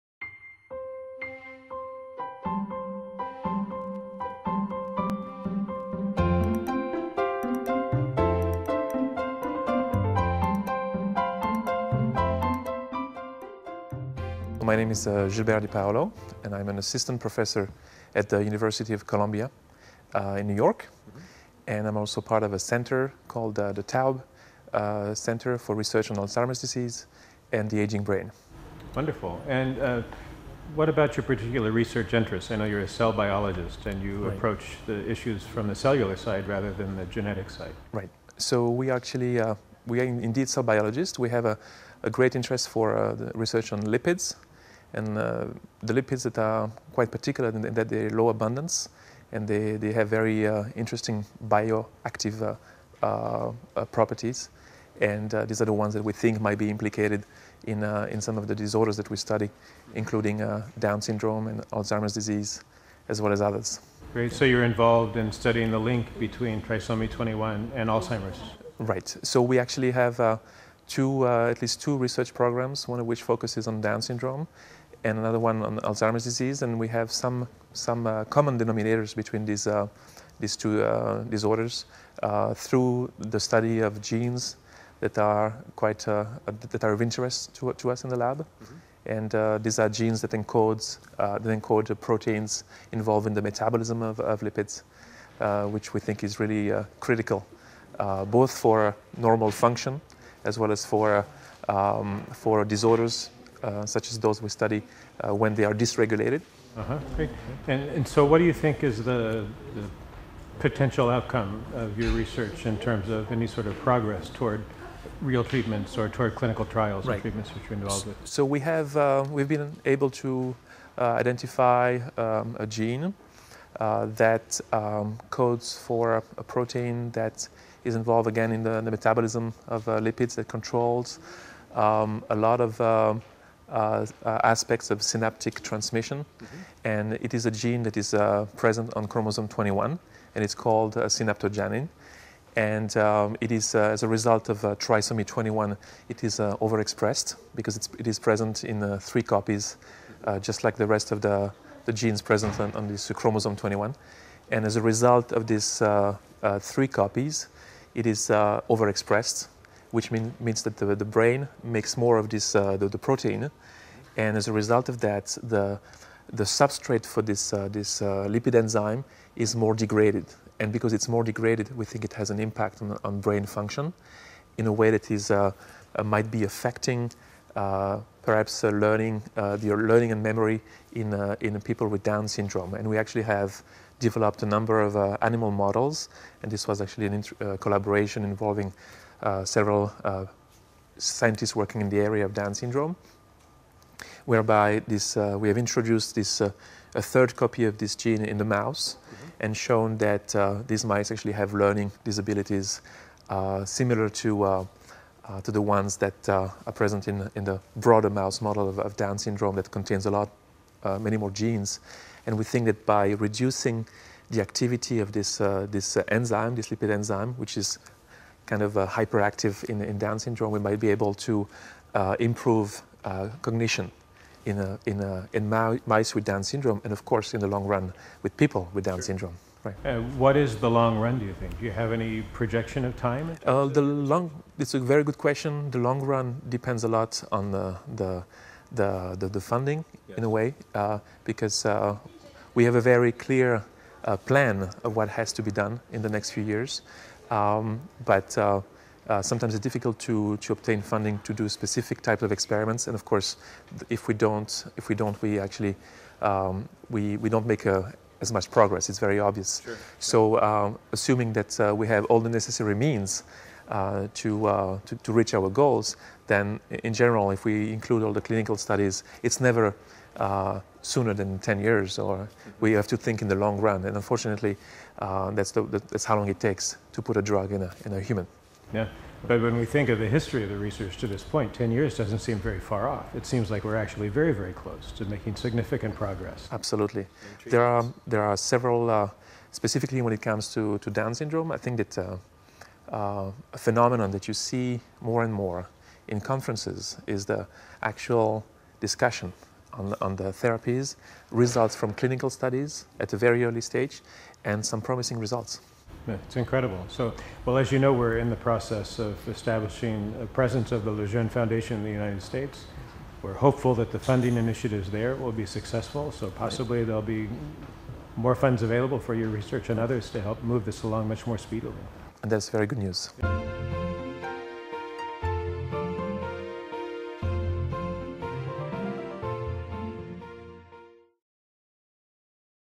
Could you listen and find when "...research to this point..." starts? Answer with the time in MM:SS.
04:40.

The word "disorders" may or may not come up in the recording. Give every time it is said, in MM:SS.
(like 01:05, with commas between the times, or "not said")
00:58, 01:21, 01:42.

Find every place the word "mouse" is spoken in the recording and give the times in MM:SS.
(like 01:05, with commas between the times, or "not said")
03:18, 03:28.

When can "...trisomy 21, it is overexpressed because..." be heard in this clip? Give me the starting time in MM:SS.
02:24.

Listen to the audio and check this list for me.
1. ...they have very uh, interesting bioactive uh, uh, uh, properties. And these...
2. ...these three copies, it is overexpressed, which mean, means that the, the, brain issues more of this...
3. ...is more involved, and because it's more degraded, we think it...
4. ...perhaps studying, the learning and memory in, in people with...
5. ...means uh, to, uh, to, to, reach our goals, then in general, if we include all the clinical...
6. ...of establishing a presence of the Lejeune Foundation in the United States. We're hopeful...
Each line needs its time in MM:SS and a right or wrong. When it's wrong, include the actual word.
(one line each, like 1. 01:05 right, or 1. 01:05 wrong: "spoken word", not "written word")
1. 00:49 right
2. 02:35 wrong: "makes", not "issues"
3. 02:49 wrong: "degraded", not "involved"
4. 02:58 wrong: "learning", not "studying"
5. 04:22 right
6. 05:08 right.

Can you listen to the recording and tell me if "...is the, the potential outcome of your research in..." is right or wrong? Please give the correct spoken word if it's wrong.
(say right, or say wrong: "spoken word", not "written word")
right.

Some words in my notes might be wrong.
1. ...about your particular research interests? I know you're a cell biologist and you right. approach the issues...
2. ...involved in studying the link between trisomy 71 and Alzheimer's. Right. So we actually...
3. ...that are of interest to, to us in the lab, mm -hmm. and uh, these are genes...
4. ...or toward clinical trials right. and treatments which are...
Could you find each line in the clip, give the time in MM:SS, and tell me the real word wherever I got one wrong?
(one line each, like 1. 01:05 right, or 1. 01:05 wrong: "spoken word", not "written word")
1. 00:30 right
2. 01:04 wrong: "21", not "71"
3. 01:26 right
4. 01:55 right.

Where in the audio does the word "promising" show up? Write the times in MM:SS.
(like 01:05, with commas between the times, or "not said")
05:04.